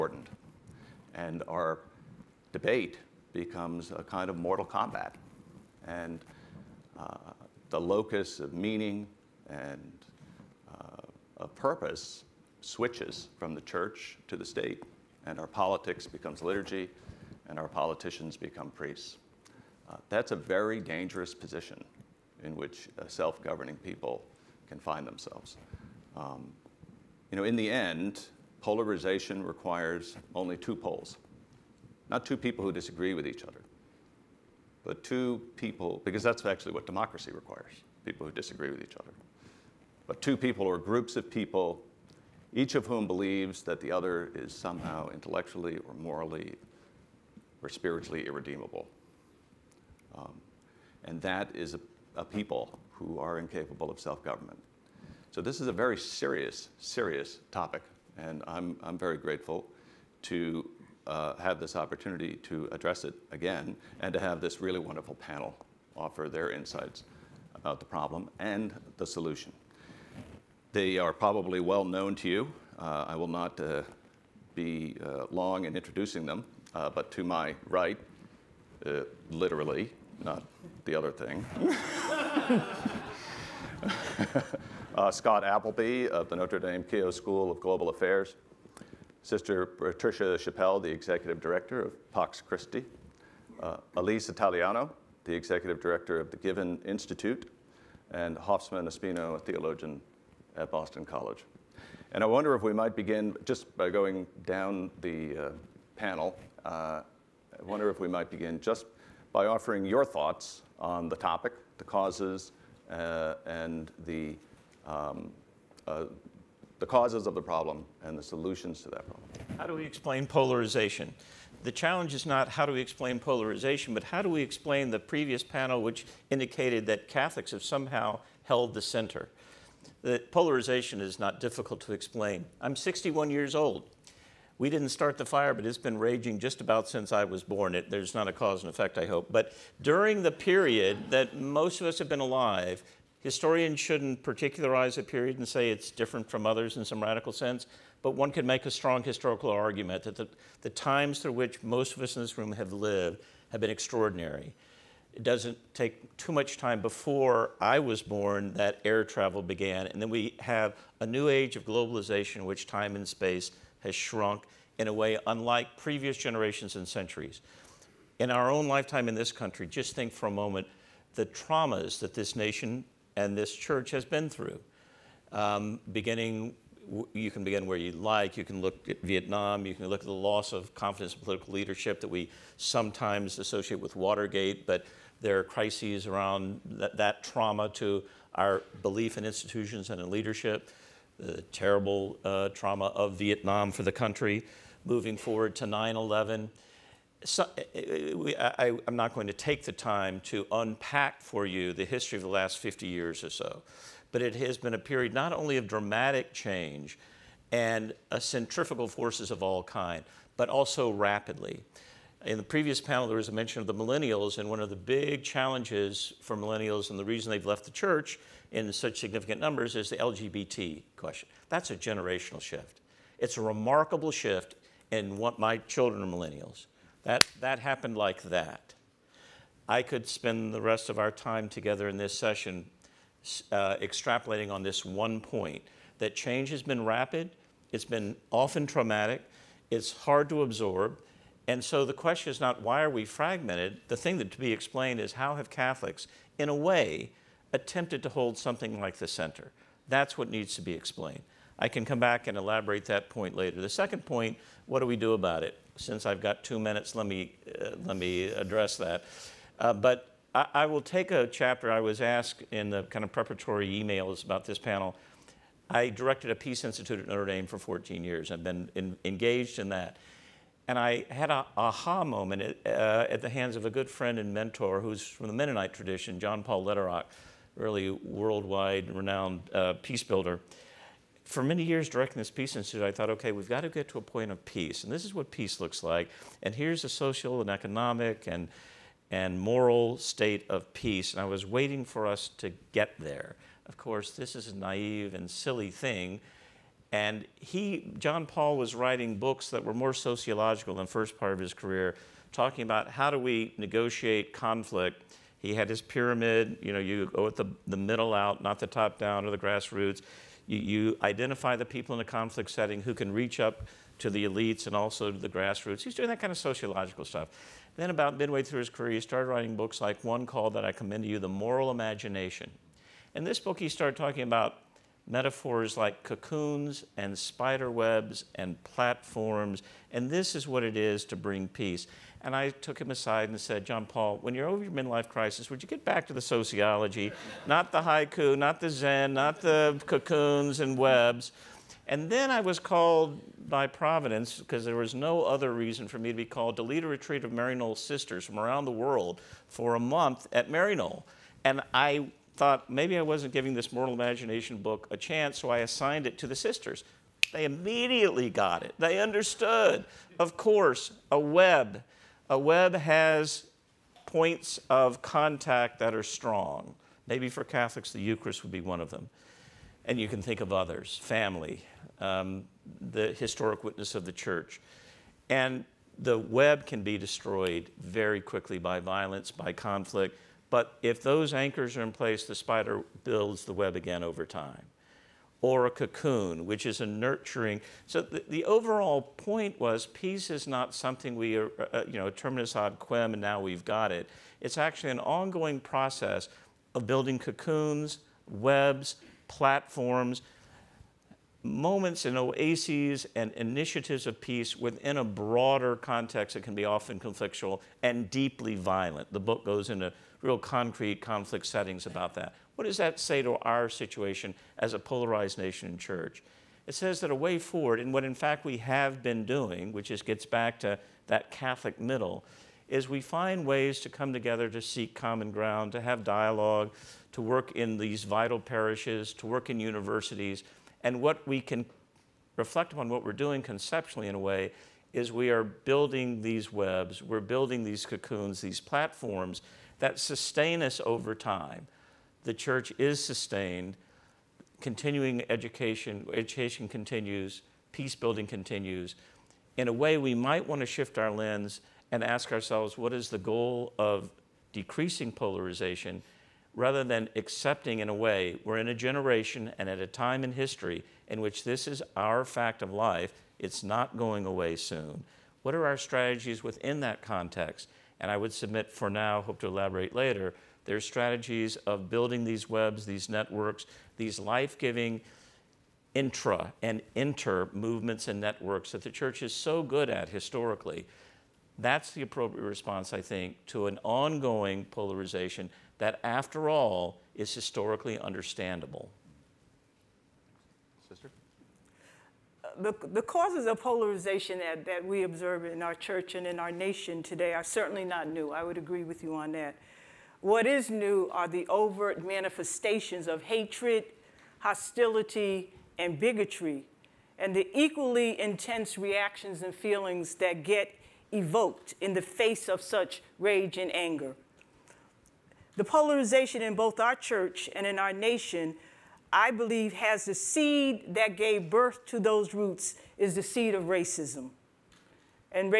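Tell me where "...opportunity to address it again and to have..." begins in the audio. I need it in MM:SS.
01:01.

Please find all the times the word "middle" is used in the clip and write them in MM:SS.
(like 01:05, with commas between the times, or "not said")
05:07, 07:01.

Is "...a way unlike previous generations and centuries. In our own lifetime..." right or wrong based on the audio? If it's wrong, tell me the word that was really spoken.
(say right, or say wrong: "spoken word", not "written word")
right.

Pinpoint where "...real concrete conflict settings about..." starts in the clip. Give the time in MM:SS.
06:50.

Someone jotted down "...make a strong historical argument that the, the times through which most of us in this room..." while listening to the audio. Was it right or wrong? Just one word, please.
right.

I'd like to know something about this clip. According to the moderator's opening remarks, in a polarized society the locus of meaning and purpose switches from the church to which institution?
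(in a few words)
the state.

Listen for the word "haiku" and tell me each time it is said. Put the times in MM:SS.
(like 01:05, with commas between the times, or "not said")
05:37.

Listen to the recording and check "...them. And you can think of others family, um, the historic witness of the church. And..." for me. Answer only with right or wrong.
right.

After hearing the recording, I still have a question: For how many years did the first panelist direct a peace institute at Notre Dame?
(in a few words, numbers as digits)
14.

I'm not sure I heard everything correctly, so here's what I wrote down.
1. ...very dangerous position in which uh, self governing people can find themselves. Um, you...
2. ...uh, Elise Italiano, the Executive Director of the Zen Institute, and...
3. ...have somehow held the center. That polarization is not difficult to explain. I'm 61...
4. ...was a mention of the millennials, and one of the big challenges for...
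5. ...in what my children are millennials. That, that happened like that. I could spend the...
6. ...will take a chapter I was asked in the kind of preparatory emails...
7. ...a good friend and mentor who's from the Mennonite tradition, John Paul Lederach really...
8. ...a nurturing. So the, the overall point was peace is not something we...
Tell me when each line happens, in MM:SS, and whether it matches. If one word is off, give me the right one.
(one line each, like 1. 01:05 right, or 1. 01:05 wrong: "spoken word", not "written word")
1. 00:20 right
2. 01:33 wrong: "Given", not "Zen"
3. 02:07 right
4. 03:33 right
5. 03:44 right
6. 04:20 right
7. 04:33 right
8. 06:26 right.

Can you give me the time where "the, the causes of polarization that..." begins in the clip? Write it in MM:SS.
08:12.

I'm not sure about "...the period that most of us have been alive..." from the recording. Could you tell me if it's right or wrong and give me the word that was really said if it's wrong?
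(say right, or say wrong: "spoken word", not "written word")
right.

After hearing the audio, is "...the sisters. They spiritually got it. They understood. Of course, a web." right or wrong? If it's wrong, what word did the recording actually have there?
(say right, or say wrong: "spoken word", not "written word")
wrong: "immediately", not "spiritually".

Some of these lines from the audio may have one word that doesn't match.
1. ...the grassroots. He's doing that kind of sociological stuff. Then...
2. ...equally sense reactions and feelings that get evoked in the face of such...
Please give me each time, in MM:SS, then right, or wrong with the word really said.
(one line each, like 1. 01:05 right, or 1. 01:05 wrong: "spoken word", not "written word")
1. 05:15 right
2. 08:27 wrong: "intense", not "sense".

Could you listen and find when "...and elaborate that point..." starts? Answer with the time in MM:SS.
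04:12.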